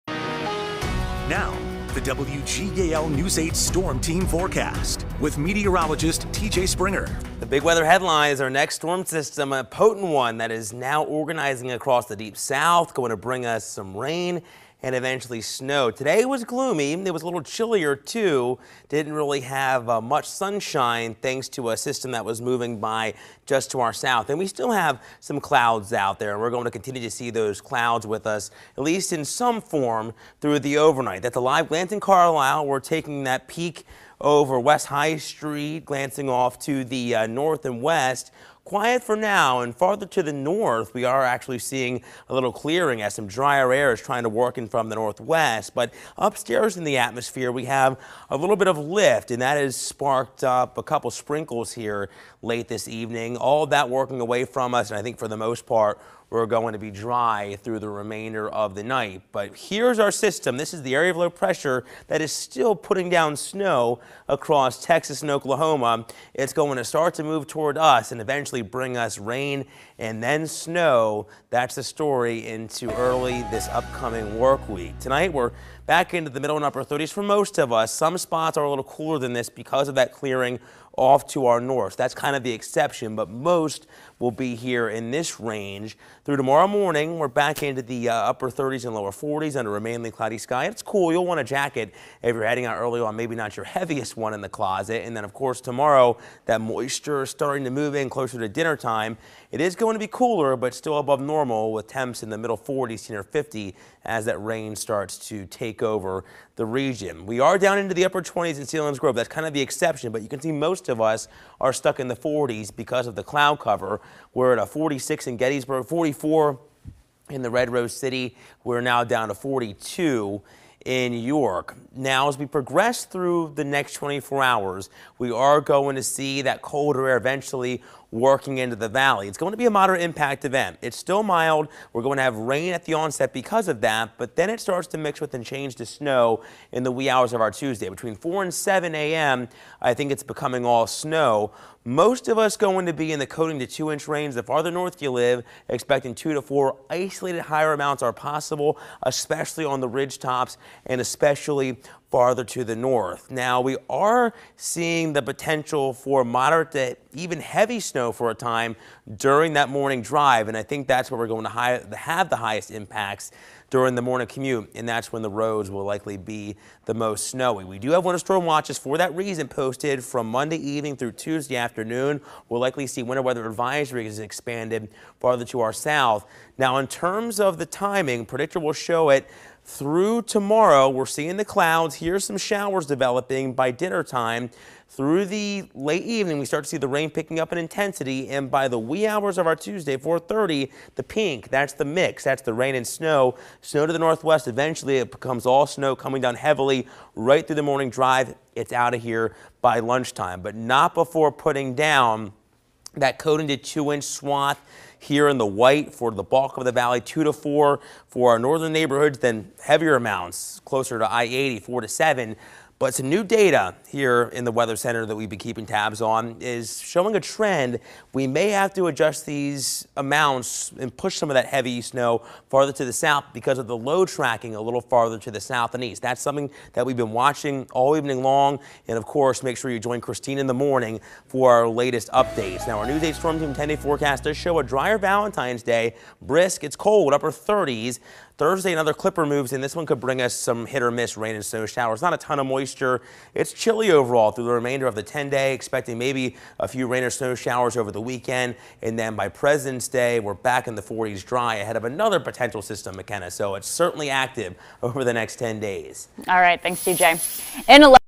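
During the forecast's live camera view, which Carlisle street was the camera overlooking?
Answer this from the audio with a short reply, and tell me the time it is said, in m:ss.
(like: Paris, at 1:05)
West High Street, at 0:34.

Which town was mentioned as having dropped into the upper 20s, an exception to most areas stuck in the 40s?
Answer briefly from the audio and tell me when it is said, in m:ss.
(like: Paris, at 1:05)
Selinsgrove, at 1:48.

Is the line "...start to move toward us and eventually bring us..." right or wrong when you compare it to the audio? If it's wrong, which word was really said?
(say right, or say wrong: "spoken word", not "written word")
right.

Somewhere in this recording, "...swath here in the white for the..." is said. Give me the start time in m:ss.
3:24.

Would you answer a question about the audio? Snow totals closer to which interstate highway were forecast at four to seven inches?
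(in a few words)
I-80.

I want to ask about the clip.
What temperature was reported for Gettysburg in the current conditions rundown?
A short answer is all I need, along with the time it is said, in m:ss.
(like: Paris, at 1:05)
46, at 1:54.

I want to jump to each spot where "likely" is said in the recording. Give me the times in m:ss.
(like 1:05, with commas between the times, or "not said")
2:45, 2:52.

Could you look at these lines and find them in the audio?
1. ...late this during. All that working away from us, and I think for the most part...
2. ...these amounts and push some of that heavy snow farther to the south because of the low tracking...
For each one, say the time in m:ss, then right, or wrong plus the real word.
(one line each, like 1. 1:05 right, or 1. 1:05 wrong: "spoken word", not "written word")
1. 0:52 wrong: "evening", not "during"
2. 3:39 right.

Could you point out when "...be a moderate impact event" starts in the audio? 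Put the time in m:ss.
2:09.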